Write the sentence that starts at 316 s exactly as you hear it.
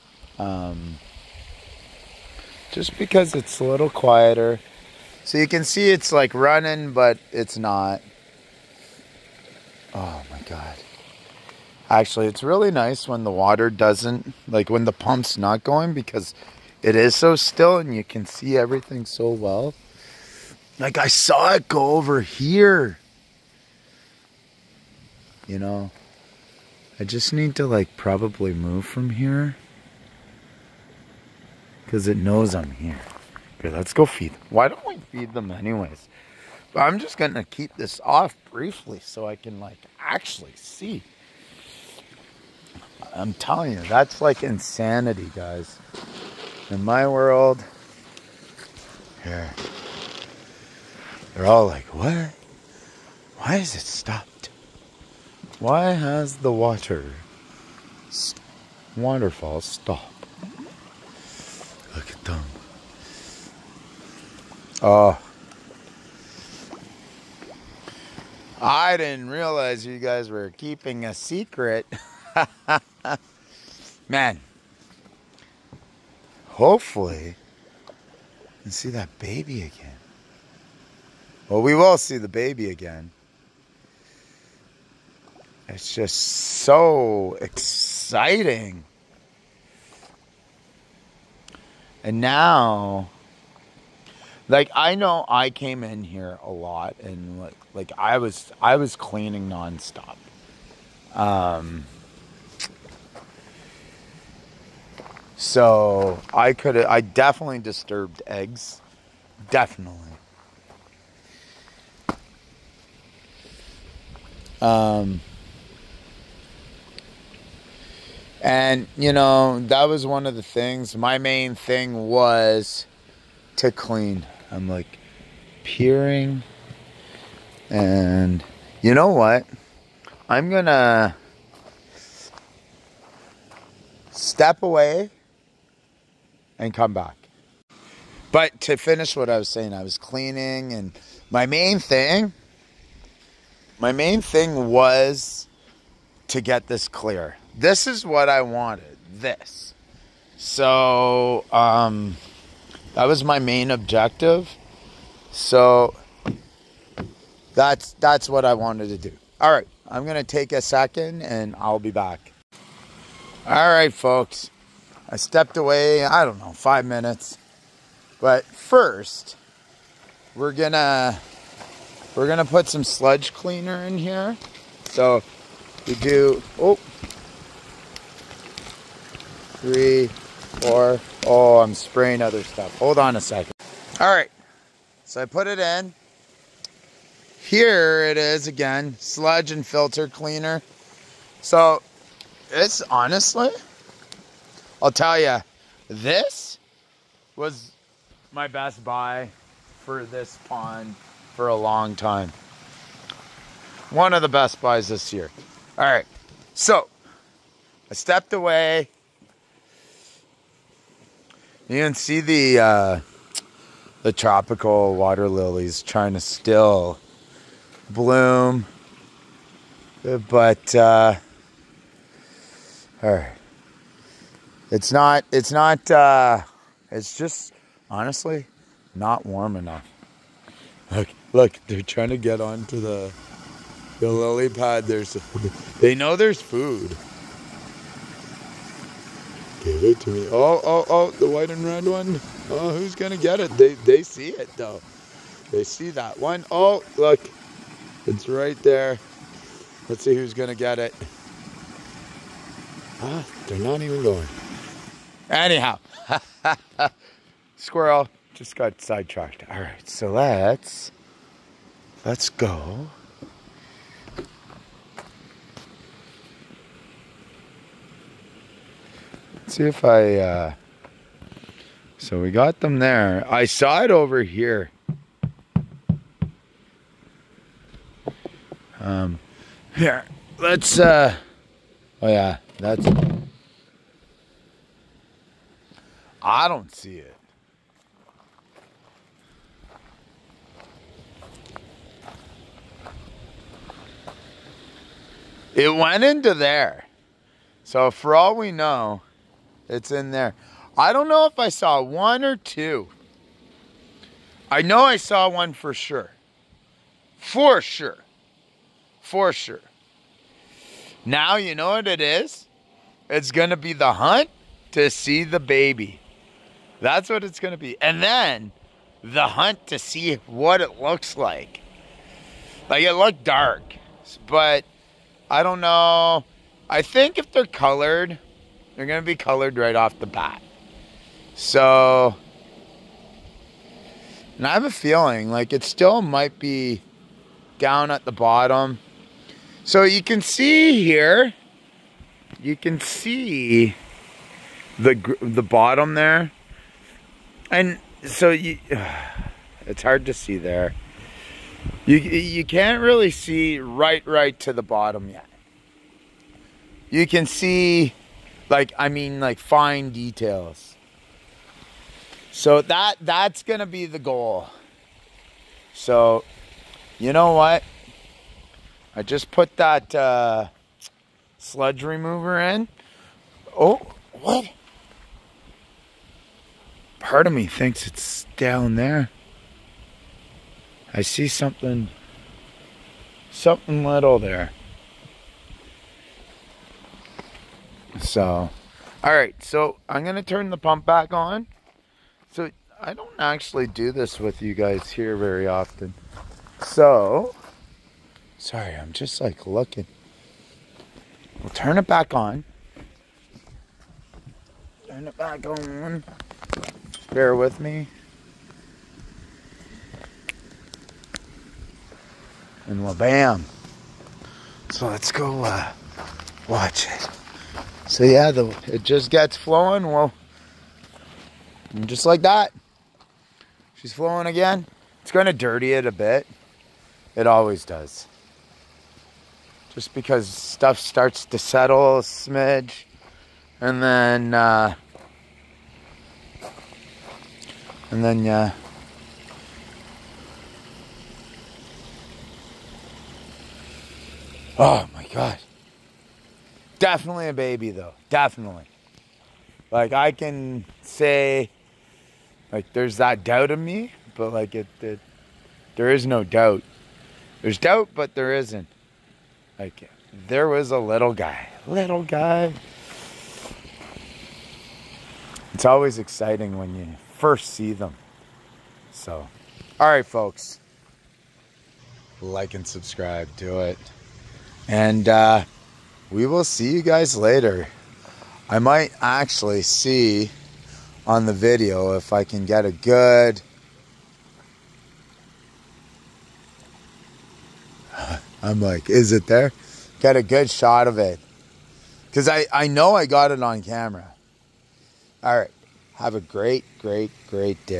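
That's what it's going to be.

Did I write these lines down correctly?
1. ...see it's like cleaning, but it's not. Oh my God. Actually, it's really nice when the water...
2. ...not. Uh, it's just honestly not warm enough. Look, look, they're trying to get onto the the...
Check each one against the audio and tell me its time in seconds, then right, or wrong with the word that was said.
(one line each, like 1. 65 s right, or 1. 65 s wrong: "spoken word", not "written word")
1. 5 s wrong: "running", not "cleaning"
2. 225 s right.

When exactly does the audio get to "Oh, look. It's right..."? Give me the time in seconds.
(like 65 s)
246 s.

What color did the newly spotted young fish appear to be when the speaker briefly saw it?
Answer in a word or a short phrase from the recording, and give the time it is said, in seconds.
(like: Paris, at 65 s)
Dark, at 322 s.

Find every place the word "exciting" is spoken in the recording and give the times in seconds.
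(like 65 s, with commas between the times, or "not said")
87 s, 465 s.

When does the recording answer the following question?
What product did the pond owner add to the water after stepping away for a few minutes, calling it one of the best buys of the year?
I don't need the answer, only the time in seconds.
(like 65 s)
188 s.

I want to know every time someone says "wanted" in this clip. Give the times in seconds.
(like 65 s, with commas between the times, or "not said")
148 s, 158 s.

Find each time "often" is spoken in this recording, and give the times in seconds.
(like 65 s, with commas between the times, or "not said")
395 s.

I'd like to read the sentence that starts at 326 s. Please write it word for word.
I think if they're colored, they're going to be colored right off the bat.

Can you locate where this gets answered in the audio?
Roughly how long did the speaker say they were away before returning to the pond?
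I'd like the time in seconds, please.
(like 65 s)
166 s.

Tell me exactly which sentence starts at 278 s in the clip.
Um, here, let's, uh, oh yeah, that's, I don't see it.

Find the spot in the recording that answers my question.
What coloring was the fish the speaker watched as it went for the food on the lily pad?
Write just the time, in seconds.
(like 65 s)
241 s.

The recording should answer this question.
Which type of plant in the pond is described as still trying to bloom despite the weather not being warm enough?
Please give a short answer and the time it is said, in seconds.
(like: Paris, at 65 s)
Tropical water lilies, at 214 s.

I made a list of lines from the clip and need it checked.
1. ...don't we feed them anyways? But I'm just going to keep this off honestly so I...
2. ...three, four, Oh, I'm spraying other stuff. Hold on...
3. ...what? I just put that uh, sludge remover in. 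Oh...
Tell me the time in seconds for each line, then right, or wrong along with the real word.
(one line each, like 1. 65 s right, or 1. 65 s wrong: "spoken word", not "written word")
1. 34 s wrong: "briefly", not "honestly"
2. 179 s right
3. 367 s right.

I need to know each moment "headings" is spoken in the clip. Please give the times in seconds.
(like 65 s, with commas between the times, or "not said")
not said.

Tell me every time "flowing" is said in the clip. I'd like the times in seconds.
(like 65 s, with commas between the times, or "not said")
419 s, 423 s.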